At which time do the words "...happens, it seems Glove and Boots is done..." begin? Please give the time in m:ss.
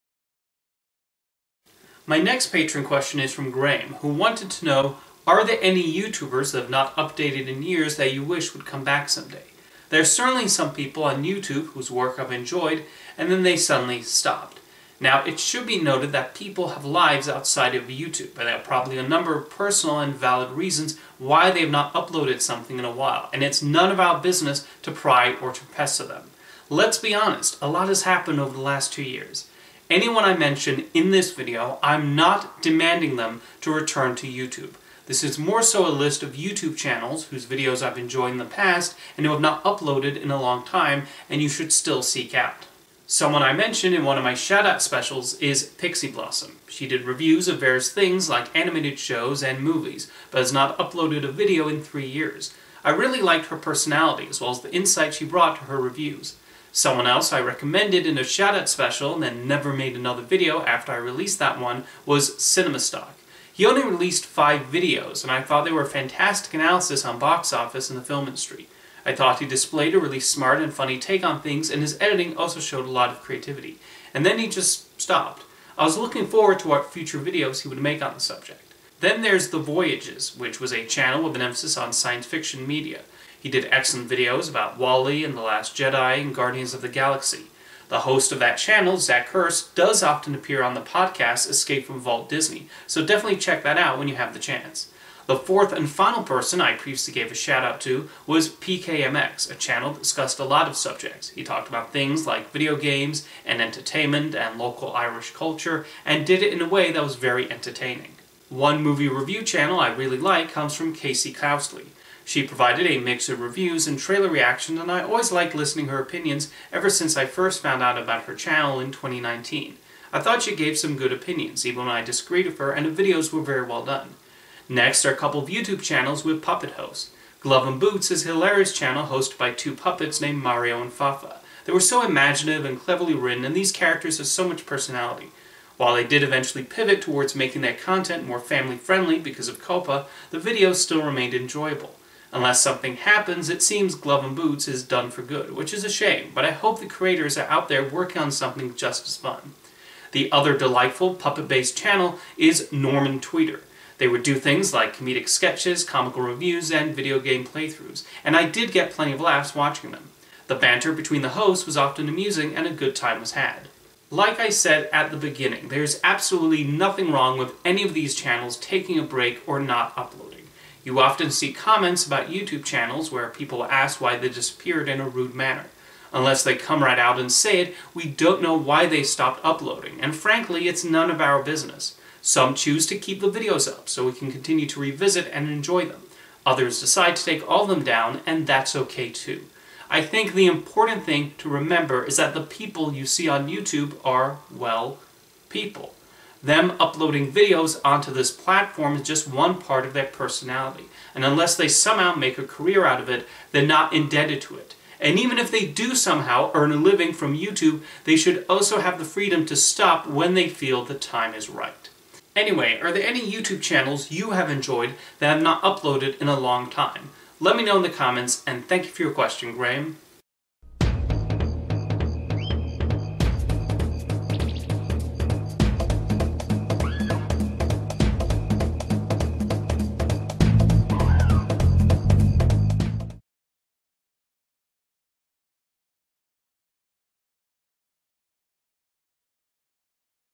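2:22.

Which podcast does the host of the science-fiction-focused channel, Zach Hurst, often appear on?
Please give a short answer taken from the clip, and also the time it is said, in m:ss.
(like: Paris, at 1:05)
Escape from Walt Disney, at 1:31.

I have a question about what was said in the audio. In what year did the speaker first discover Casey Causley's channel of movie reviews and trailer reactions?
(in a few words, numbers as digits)
2019.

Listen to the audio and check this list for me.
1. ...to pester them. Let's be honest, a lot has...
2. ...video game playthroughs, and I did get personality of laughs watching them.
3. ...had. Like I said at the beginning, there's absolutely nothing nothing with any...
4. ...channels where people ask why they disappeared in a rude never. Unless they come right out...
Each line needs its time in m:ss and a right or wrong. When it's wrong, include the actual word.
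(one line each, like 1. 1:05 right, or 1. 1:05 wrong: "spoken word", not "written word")
1. 0:25 right
2. 2:36 wrong: "plenty", not "personality"
3. 2:43 wrong: "wrong", not "nothing"
4. 2:52 wrong: "manner", not "never".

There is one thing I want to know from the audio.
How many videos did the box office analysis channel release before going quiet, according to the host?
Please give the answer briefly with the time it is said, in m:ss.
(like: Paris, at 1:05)
5, at 1:04.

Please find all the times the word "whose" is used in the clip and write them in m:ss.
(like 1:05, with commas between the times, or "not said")
0:11, 0:37.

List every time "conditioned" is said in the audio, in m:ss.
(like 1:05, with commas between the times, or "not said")
not said.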